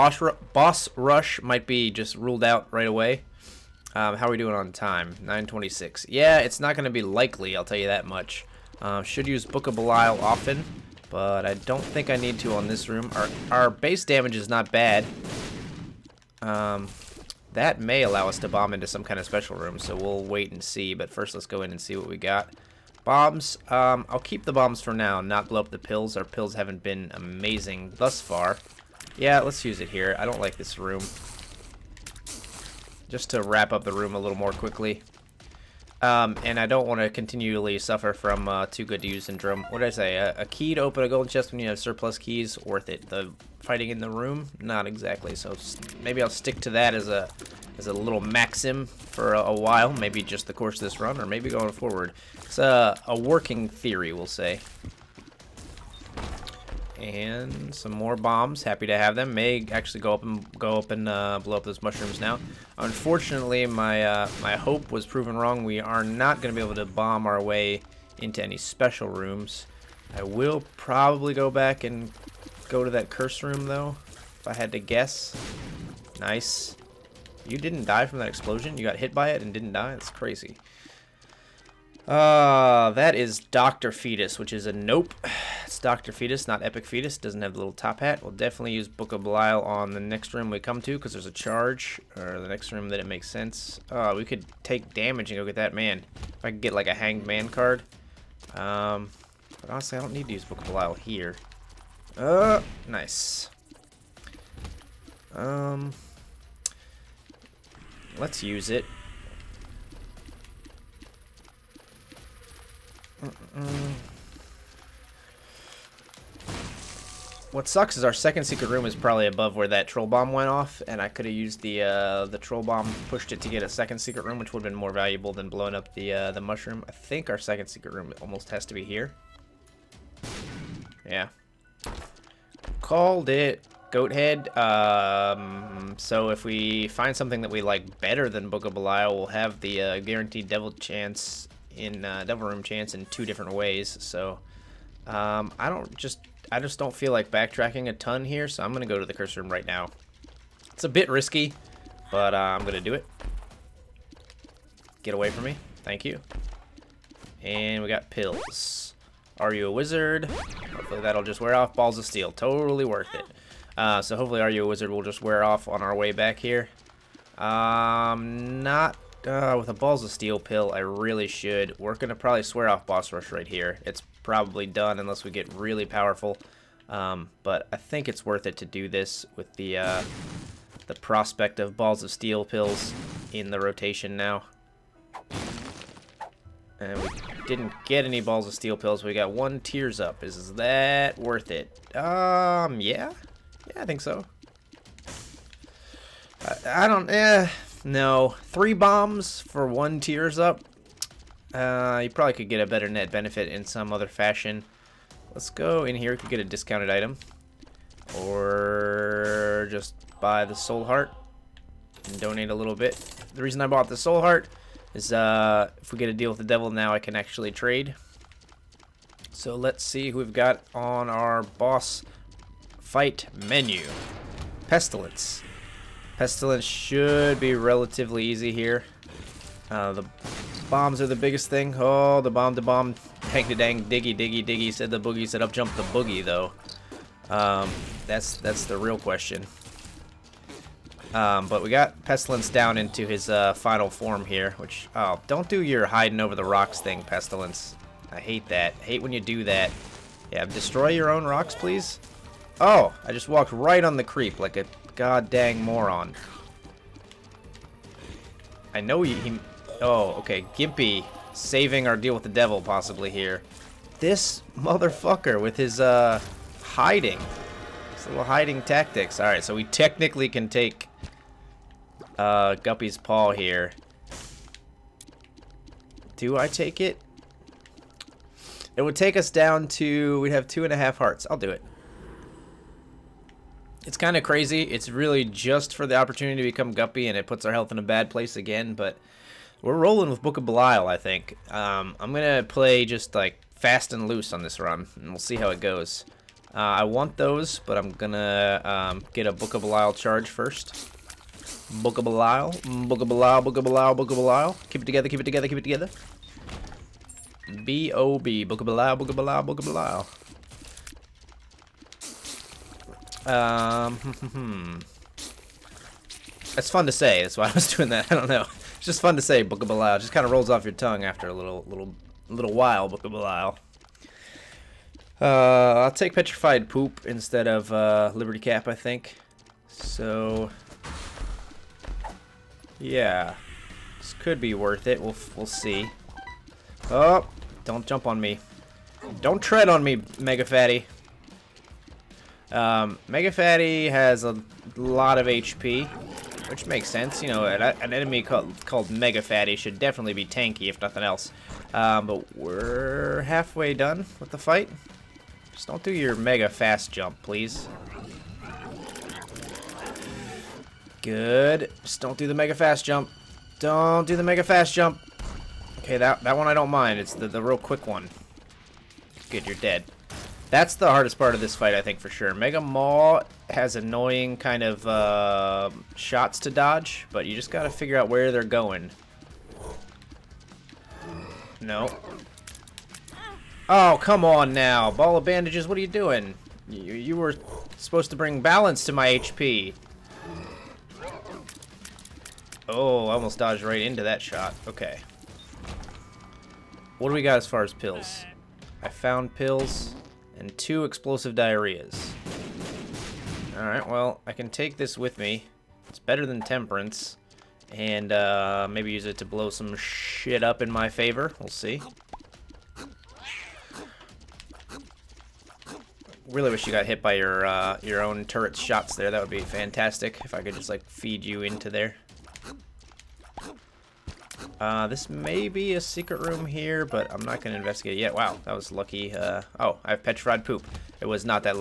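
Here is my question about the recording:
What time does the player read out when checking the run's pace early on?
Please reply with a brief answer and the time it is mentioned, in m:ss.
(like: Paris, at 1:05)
926, at 0:05.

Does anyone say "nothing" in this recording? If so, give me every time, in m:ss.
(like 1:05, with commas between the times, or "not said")
5:50.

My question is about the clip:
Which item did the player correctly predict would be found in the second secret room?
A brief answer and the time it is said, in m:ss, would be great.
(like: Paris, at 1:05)
Goathead, at 2:13.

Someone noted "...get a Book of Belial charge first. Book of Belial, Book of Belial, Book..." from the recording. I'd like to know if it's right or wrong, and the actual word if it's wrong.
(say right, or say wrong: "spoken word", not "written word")
right.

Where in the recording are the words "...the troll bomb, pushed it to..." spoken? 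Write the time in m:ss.
2:02.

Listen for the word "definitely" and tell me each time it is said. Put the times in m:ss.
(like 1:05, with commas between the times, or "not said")
1:28, 5:49.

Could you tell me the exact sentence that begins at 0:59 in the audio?
May actually go up and go up and uh, blow up those mushrooms now.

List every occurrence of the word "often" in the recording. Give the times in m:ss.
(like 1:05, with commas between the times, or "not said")
0:10.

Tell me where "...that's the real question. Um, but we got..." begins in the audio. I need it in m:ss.
3:58.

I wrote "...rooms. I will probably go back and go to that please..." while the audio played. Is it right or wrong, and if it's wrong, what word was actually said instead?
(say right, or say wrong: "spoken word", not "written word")
wrong: "curse", not "please".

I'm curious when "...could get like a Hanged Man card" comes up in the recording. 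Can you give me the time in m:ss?
1:36.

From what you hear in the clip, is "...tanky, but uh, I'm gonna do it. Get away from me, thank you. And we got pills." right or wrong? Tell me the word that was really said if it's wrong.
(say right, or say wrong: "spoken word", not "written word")
wrong: "risky", not "tanky".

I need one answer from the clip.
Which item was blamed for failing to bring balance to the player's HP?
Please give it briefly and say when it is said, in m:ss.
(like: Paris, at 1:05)
Ball of bandages, at 6:24.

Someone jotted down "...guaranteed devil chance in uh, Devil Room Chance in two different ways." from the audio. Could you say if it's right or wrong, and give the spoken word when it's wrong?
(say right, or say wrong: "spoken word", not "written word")
right.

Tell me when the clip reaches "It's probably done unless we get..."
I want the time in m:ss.
2:53.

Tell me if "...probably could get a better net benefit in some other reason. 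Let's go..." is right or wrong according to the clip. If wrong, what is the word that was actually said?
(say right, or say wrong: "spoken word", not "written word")
wrong: "fashion", not "reason".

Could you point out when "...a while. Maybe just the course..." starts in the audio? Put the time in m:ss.
0:49.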